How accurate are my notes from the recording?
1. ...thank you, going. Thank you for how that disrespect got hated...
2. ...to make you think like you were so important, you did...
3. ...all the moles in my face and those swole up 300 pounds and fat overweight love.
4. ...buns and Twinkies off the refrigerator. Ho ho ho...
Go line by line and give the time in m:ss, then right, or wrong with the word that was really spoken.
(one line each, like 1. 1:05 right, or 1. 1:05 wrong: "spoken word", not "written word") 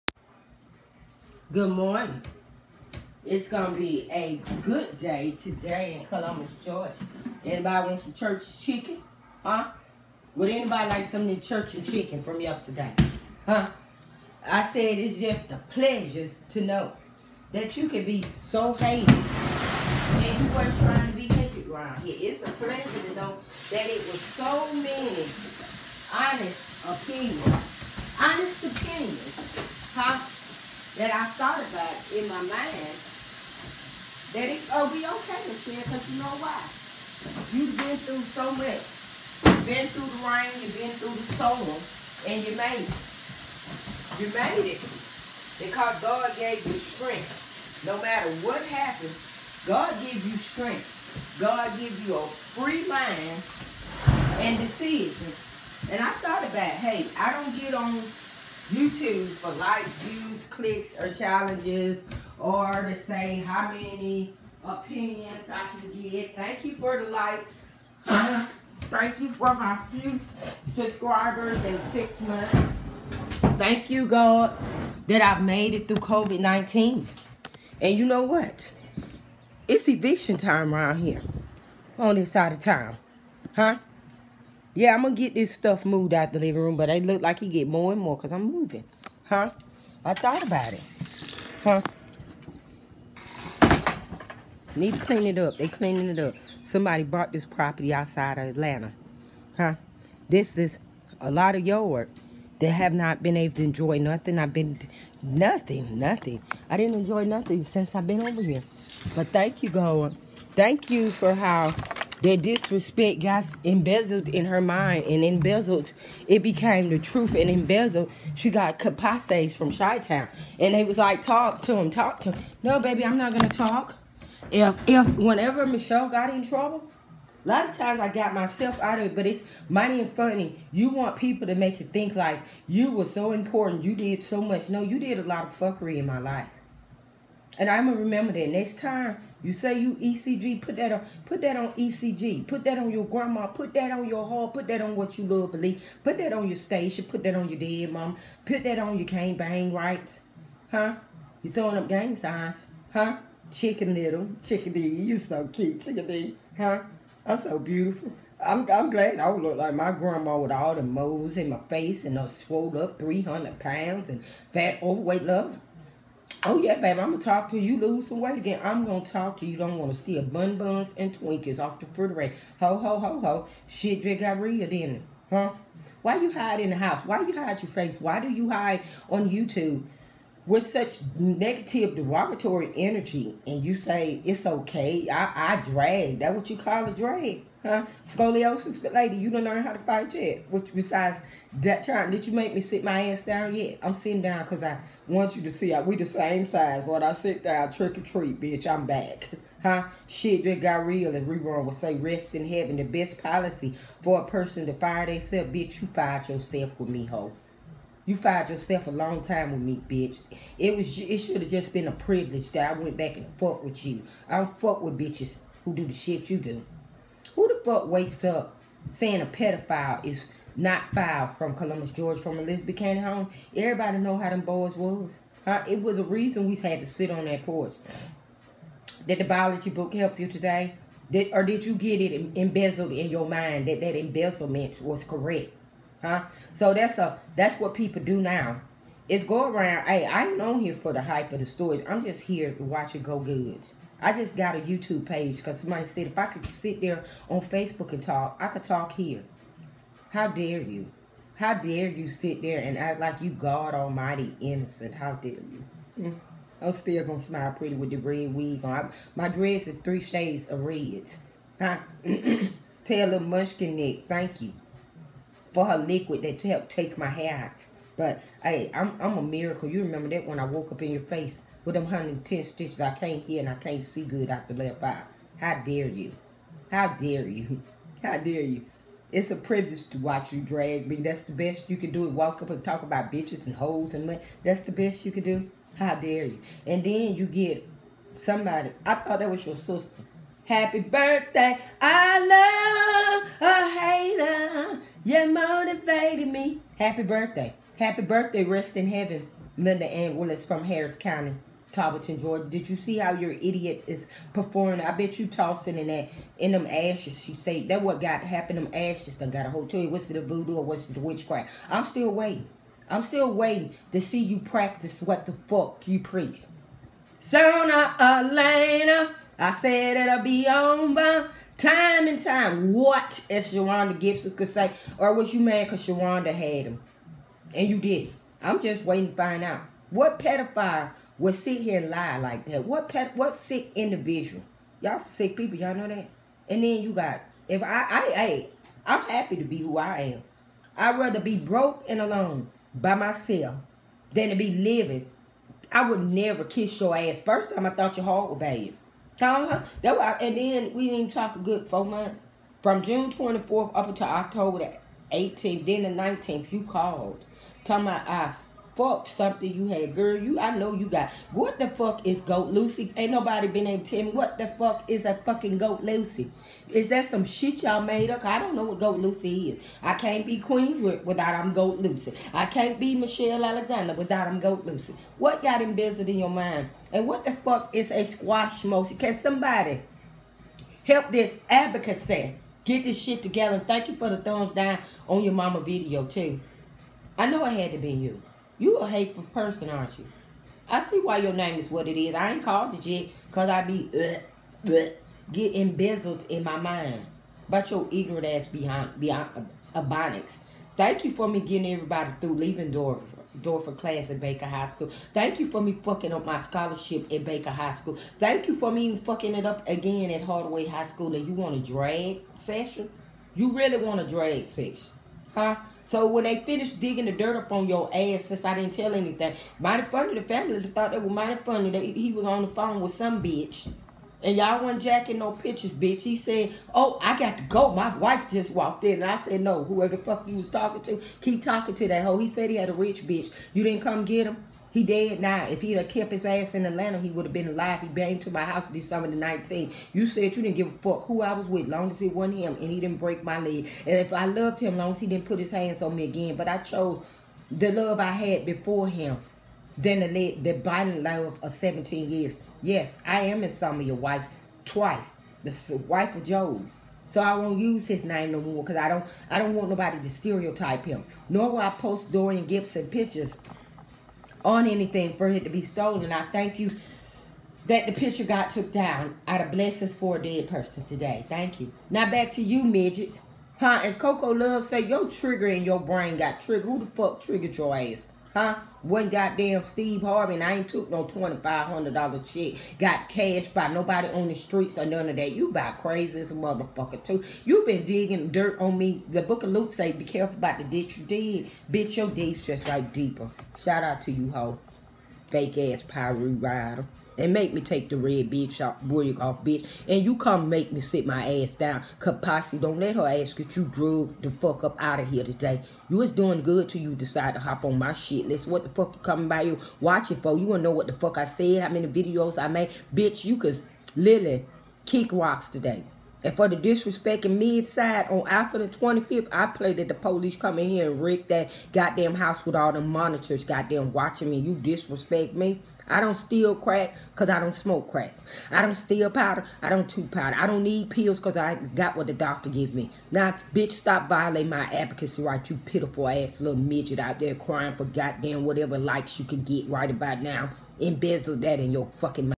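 1. 1:49 wrong: "embezzled", not "hated"
2. 2:11 right
3. 2:40 right
4. 2:50 right.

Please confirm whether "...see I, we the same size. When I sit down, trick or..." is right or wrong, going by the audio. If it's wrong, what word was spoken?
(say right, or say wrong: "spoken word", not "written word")
right.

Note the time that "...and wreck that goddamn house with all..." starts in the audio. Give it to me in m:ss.
8:40.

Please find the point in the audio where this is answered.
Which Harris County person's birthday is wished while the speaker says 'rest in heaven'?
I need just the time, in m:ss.
4:59.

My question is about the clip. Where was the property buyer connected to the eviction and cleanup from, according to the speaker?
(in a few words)
Outside of Atlanta.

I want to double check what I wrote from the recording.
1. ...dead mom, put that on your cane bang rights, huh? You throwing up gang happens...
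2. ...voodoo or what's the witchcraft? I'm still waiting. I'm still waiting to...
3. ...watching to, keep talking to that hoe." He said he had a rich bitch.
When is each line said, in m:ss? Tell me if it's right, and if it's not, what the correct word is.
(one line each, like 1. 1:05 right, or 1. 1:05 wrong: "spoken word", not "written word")
1. 2:27 wrong: "signs", not "happens"
2. 5:10 right
3. 7:10 wrong: "talking", not "watching".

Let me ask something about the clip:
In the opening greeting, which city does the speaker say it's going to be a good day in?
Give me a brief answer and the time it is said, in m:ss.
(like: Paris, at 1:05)
Columbus, Georgia, at 0:06.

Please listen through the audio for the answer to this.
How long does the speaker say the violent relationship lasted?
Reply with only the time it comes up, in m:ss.
7:31.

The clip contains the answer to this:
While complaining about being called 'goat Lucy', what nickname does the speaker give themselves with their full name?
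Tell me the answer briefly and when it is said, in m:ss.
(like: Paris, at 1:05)
Queen Drip, at 6:10.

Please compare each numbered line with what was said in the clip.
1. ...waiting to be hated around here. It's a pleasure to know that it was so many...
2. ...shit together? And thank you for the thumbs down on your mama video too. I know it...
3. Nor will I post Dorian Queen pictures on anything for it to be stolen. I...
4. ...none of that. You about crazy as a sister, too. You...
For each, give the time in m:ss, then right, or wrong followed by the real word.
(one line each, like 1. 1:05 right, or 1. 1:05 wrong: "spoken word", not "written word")
1. 0:20 wrong: "trying", not "waiting"
2. 6:22 right
3. 7:41 wrong: "Gibson", not "Queen"
4. 8:04 wrong: "motherfucker", not "sister".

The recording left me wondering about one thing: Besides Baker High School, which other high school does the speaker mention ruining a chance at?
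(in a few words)
Hardaway High School.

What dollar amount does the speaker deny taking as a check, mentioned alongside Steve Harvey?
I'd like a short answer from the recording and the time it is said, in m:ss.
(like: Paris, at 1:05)
$2,500, at 8:01.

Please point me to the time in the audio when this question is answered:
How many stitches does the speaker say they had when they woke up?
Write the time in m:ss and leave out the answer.
4:31.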